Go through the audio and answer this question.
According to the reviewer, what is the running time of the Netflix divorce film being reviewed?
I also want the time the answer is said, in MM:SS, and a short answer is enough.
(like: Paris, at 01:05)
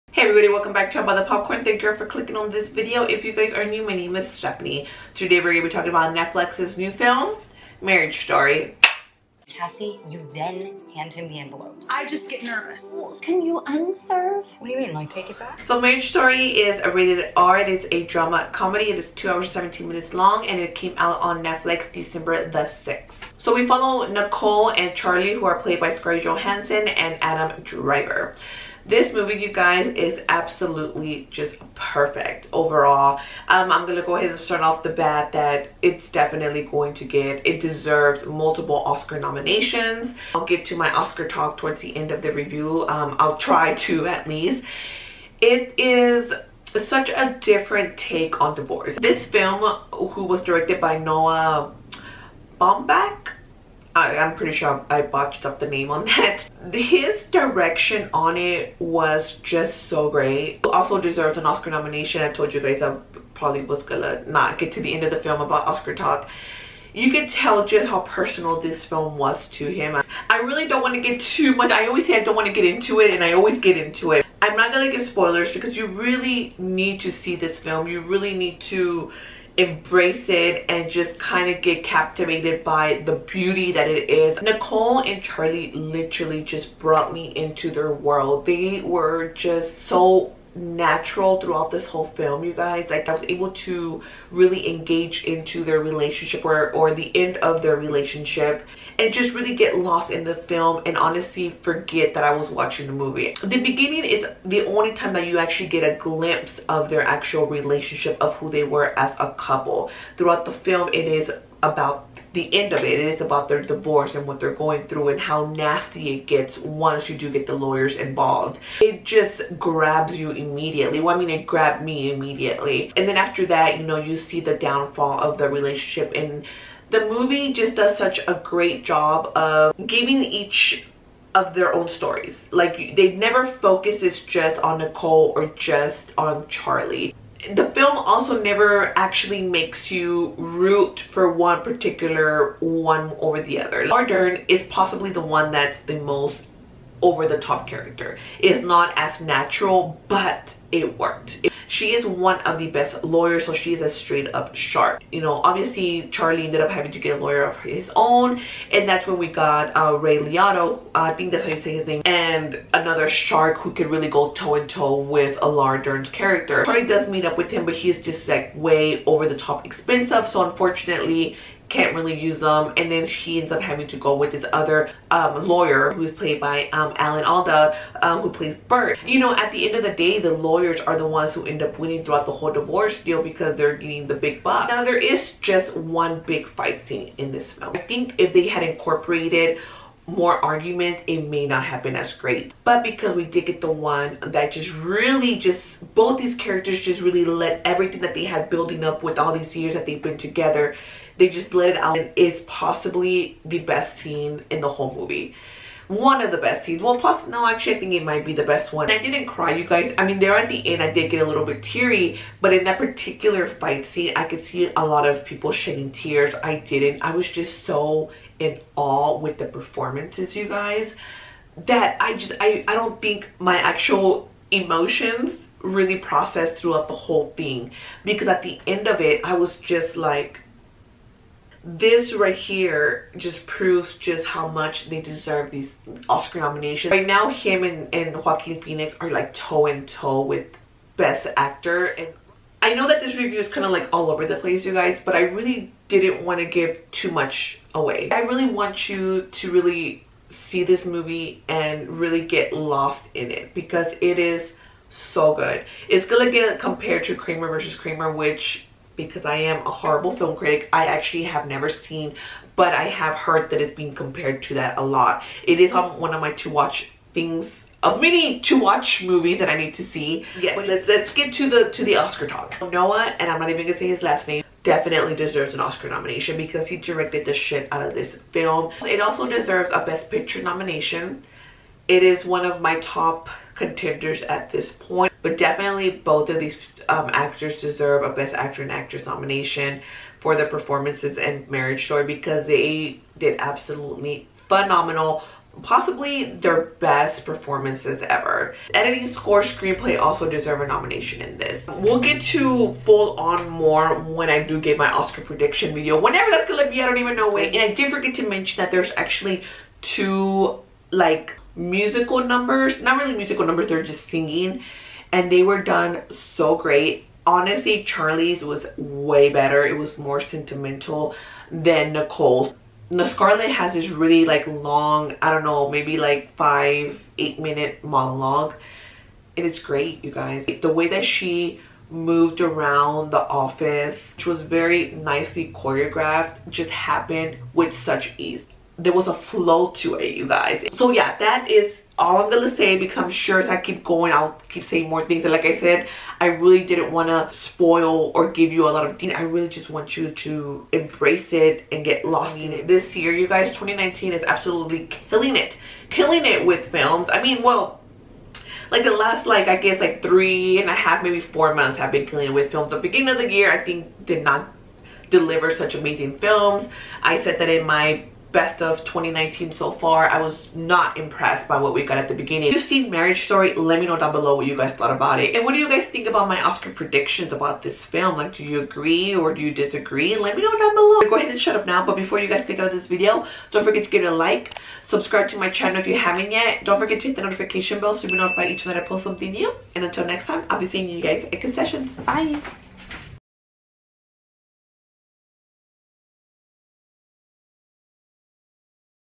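2 hours 17 minutes, at 00:19.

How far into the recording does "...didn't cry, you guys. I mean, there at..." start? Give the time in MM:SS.
03:28.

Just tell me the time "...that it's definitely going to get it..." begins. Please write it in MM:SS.
00:35.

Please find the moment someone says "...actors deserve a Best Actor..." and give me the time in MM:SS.
04:47.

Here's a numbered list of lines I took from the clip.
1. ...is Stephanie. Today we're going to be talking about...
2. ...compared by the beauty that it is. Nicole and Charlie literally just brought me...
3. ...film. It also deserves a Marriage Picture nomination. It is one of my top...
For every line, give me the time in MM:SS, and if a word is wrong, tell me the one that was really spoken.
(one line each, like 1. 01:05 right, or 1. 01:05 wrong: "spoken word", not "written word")
1. 00:04 right
2. 01:21 wrong: "captivated", not "compared"
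3. 04:38 wrong: "Best", not "Marriage".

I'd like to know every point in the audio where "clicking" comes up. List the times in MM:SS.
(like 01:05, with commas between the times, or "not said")
00:02.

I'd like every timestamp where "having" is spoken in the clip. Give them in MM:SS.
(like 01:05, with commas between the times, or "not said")
02:36, 02:53.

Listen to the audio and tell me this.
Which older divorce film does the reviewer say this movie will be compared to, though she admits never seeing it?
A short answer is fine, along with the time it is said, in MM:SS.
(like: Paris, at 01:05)
Kramer versus Kramer, at 04:17.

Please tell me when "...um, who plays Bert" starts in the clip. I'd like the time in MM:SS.
02:58.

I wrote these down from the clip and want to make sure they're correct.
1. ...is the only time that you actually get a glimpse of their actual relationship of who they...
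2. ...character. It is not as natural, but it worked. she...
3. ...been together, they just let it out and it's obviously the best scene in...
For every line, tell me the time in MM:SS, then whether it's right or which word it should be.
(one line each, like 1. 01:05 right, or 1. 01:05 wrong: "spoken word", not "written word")
1. 01:44 right
2. 02:27 right
3. 03:20 wrong: "possibly", not "obviously".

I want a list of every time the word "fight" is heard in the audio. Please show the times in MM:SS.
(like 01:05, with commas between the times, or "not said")
03:06, 03:33.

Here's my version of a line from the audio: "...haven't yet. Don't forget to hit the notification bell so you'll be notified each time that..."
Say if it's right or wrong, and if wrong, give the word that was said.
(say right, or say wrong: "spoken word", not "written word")
right.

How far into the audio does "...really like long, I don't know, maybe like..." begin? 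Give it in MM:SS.
05:23.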